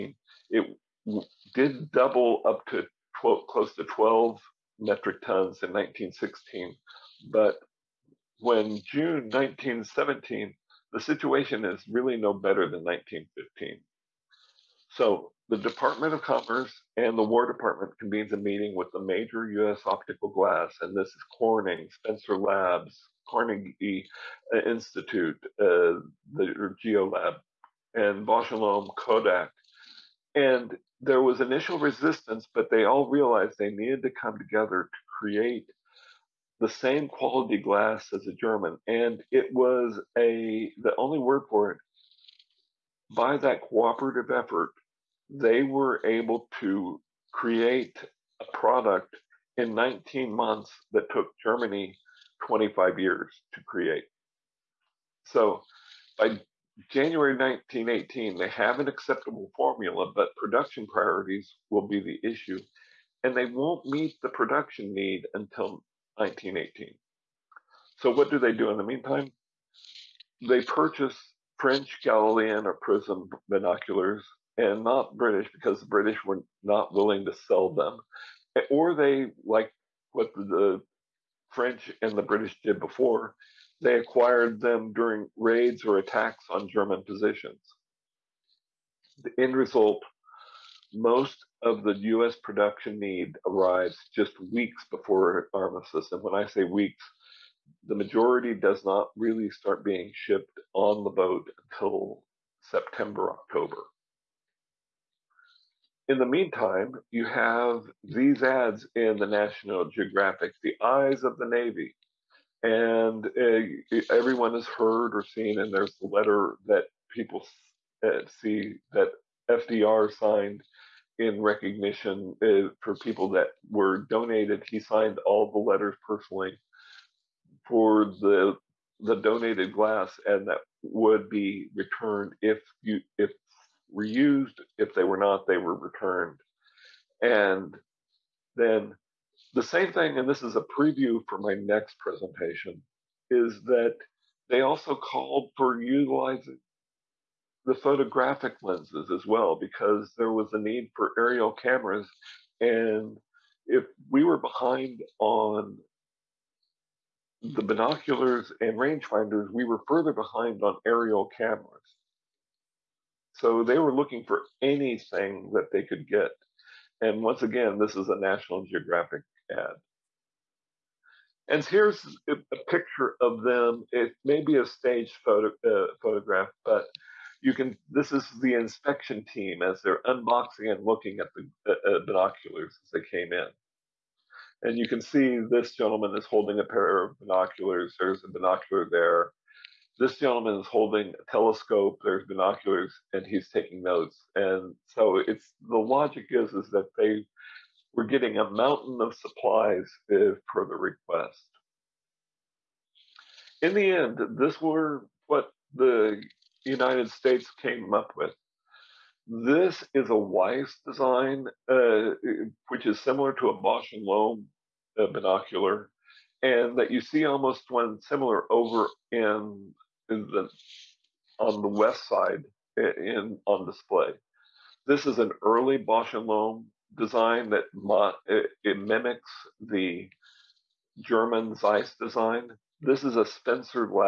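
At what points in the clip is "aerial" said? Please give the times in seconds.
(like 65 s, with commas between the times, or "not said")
151 s, 160 s.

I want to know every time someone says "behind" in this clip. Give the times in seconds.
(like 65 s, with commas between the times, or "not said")
154 s, 160 s.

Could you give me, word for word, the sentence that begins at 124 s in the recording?
He signed all the letters personally for the the donated glass, and that would be returned if you if were used.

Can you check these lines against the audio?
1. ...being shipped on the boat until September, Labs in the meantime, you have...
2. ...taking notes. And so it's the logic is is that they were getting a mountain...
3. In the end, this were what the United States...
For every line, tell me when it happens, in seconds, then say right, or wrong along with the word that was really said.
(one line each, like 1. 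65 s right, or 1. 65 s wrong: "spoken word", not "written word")
1. 99 s wrong: "October", not "Labs"
2. 193 s right
3. 203 s right.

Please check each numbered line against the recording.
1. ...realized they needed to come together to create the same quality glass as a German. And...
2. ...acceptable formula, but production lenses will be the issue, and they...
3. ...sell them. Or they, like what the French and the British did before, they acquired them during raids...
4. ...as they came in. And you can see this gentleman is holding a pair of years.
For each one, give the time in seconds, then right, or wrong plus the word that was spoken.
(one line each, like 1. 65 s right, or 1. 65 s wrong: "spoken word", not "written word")
1. 33 s right
2. 58 s wrong: "priorities", not "lenses"
3. 77 s right
4. 182 s wrong: "binoculars", not "years".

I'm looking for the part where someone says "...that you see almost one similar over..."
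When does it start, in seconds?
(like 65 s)
216 s.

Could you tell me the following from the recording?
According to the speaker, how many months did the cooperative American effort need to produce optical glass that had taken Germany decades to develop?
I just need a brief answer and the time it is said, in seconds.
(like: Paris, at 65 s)
19 months, at 49 s.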